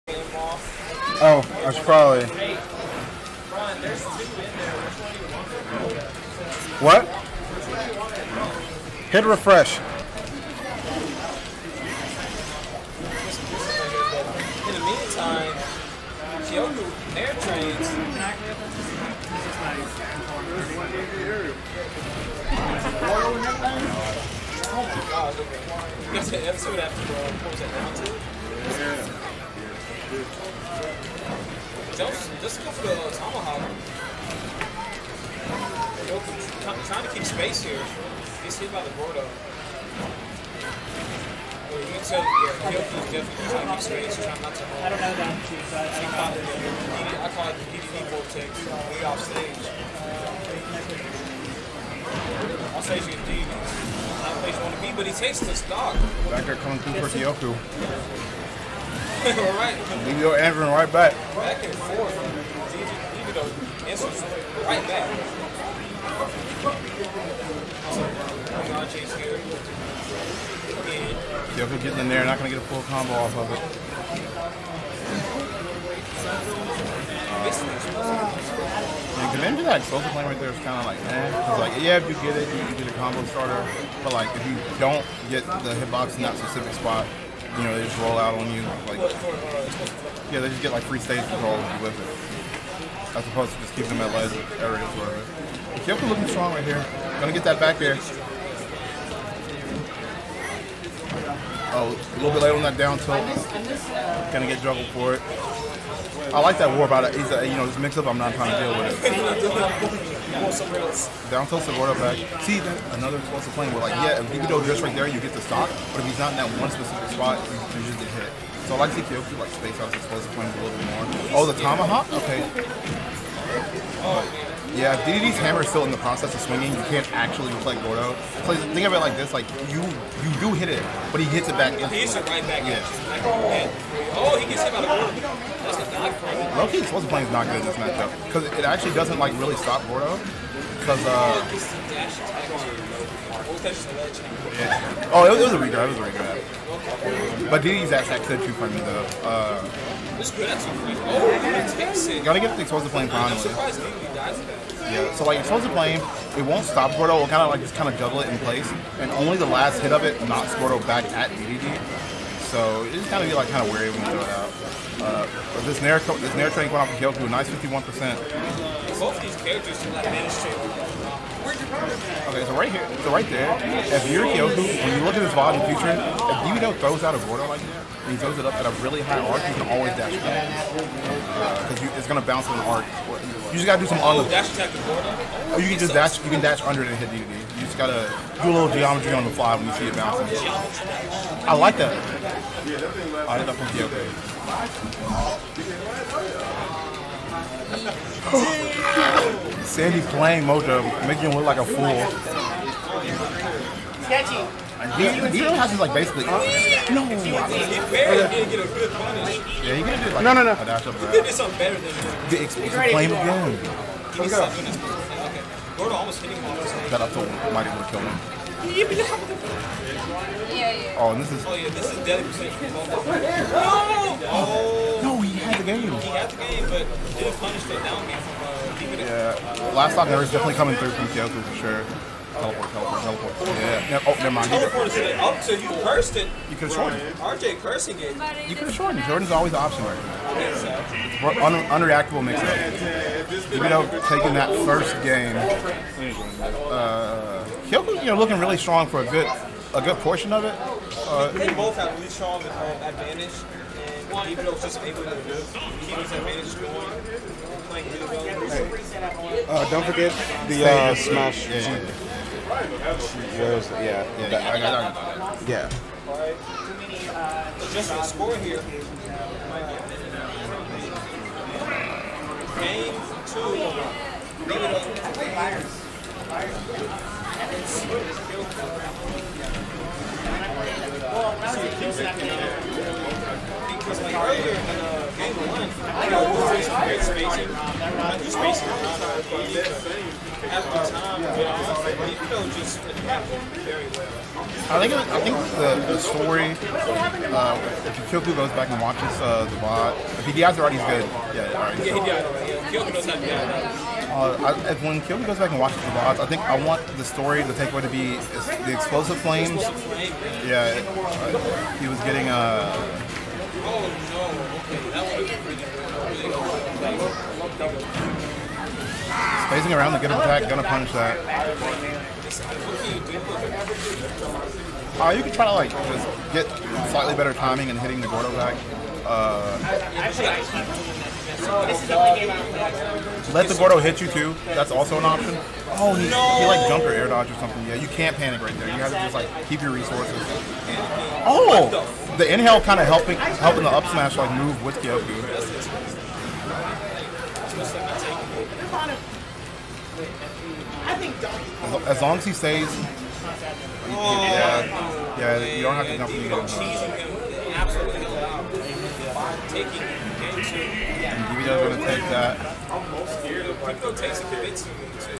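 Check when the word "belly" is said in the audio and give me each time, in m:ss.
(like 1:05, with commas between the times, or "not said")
not said.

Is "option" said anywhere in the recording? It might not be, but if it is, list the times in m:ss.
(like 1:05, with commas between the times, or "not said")
3:59, 5:35.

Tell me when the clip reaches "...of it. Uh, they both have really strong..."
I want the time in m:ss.
4:10.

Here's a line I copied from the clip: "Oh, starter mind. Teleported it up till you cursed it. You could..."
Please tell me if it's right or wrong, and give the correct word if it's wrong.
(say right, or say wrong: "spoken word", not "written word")
wrong: "never", not "starter".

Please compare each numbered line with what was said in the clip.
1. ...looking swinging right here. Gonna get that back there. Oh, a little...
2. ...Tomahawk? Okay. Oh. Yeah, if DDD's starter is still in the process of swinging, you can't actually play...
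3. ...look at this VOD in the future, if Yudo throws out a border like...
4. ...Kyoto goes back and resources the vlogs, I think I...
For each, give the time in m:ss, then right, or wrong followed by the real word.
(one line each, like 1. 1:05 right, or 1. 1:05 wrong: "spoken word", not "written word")
1. 1:36 wrong: "strong", not "swinging"
2. 2:01 wrong: "hammer", not "starter"
3. 2:55 right
4. 5:05 wrong: "watches", not "resources".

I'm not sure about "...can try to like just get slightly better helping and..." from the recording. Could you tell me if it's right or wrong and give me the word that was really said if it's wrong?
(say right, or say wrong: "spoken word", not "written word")
wrong: "timing", not "helping".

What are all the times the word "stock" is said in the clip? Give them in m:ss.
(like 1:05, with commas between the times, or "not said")
0:55, 1:55, 3:49.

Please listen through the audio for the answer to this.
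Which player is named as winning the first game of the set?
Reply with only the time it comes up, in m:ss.
4:03.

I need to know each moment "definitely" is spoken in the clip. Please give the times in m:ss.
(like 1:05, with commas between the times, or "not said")
0:43, 1:11, 3:50.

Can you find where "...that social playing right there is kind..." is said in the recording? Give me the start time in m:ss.
1:19.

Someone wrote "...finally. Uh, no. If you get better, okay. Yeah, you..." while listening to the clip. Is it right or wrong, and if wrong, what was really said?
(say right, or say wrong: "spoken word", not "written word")
wrong: "basically", not "finally".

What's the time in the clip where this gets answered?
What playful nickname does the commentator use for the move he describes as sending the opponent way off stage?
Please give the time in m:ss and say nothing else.
0:47.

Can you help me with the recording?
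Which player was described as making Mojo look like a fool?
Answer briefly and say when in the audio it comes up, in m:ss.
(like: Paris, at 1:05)
Sandy, at 3:19.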